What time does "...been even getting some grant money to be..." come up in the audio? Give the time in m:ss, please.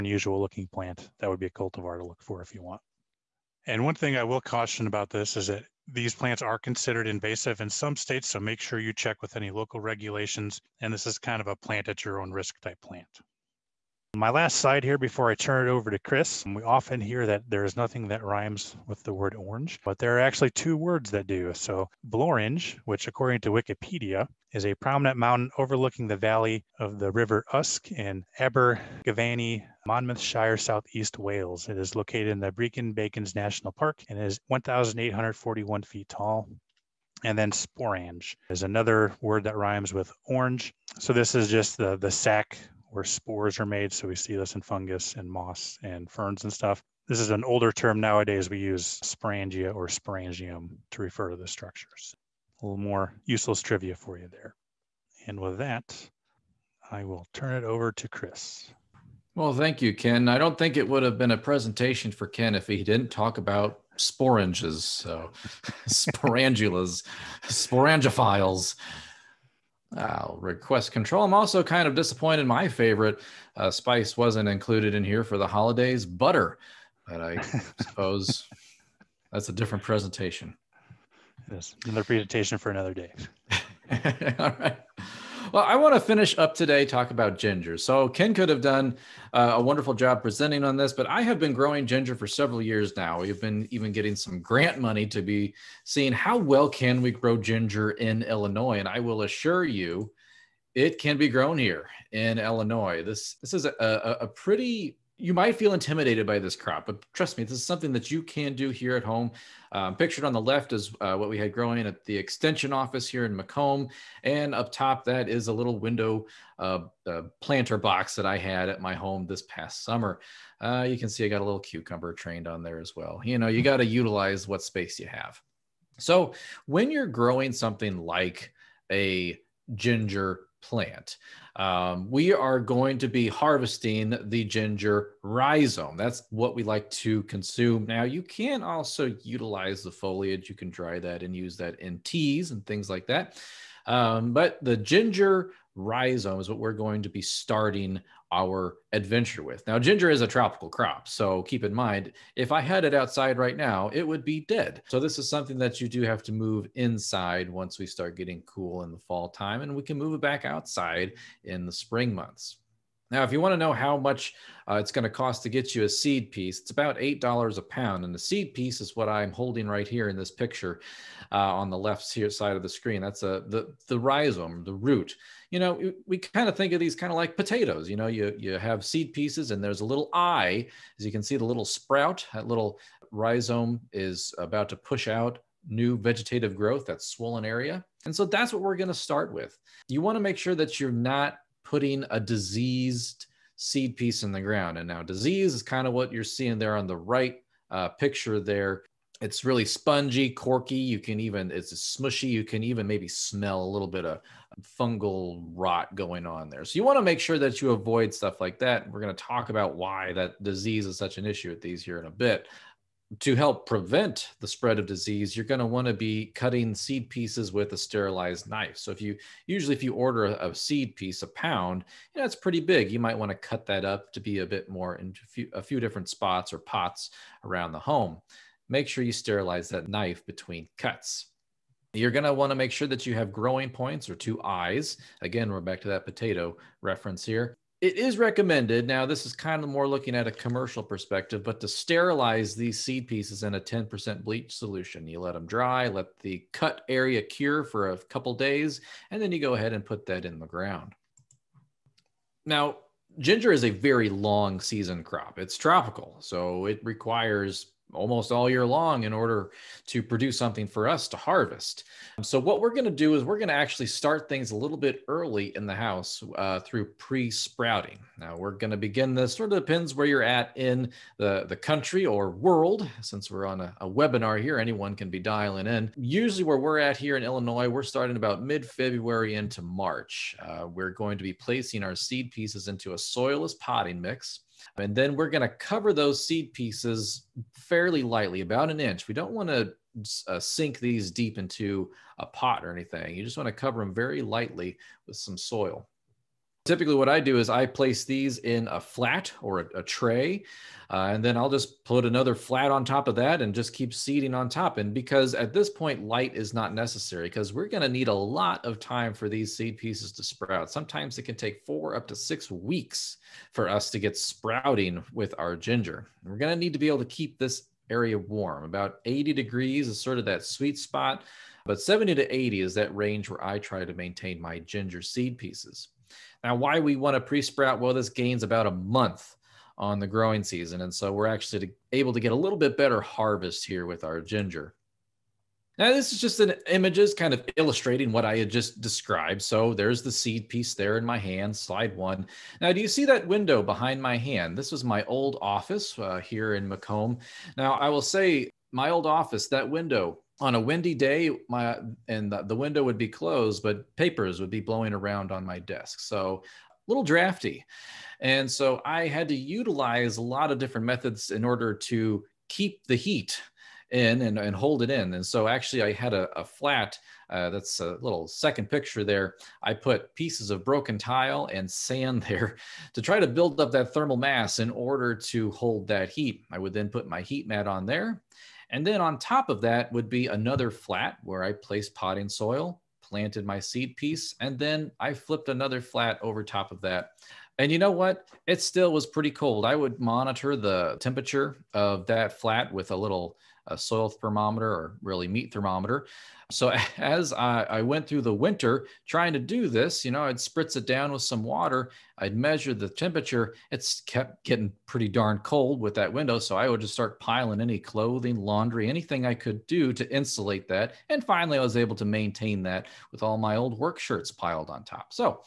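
1:33.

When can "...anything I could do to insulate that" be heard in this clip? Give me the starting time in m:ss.
6:48.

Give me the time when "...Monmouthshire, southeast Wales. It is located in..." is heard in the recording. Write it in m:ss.
0:29.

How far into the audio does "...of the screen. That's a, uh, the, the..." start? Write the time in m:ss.
2:52.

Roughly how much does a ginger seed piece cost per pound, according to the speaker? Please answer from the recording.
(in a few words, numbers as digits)
$8.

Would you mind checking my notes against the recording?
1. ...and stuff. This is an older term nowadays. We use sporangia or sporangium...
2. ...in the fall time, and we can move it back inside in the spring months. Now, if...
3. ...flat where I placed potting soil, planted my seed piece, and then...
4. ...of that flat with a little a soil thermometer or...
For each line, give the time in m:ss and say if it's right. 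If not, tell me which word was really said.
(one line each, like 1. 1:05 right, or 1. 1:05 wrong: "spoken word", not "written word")
1. 0:46 right
2. 2:38 wrong: "outside", not "inside"
3. 6:20 right
4. 6:31 right.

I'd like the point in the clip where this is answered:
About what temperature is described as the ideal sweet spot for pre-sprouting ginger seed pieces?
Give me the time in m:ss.
5:19.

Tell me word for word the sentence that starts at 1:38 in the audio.
And I will assure you, it can be grown here in Illinois.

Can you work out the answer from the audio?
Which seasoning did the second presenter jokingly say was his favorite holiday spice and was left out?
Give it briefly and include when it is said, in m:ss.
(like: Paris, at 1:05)
Butter, at 1:16.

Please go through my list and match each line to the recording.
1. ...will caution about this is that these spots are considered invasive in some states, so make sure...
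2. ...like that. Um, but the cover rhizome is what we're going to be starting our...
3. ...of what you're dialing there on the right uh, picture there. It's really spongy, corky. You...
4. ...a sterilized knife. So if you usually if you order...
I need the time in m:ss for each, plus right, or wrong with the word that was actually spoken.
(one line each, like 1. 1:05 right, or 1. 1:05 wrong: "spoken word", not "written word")
1. 0:04 wrong: "plants", not "spots"
2. 2:22 wrong: "ginger", not "cover"
3. 3:15 wrong: "seeing", not "dialing"
4. 3:37 right.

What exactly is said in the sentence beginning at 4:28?
Now, we're going to begin this, sort of depends where you're at in the, the country or world.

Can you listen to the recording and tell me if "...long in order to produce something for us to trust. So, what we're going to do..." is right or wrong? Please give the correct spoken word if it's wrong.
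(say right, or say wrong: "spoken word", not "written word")
wrong: "harvest", not "trust".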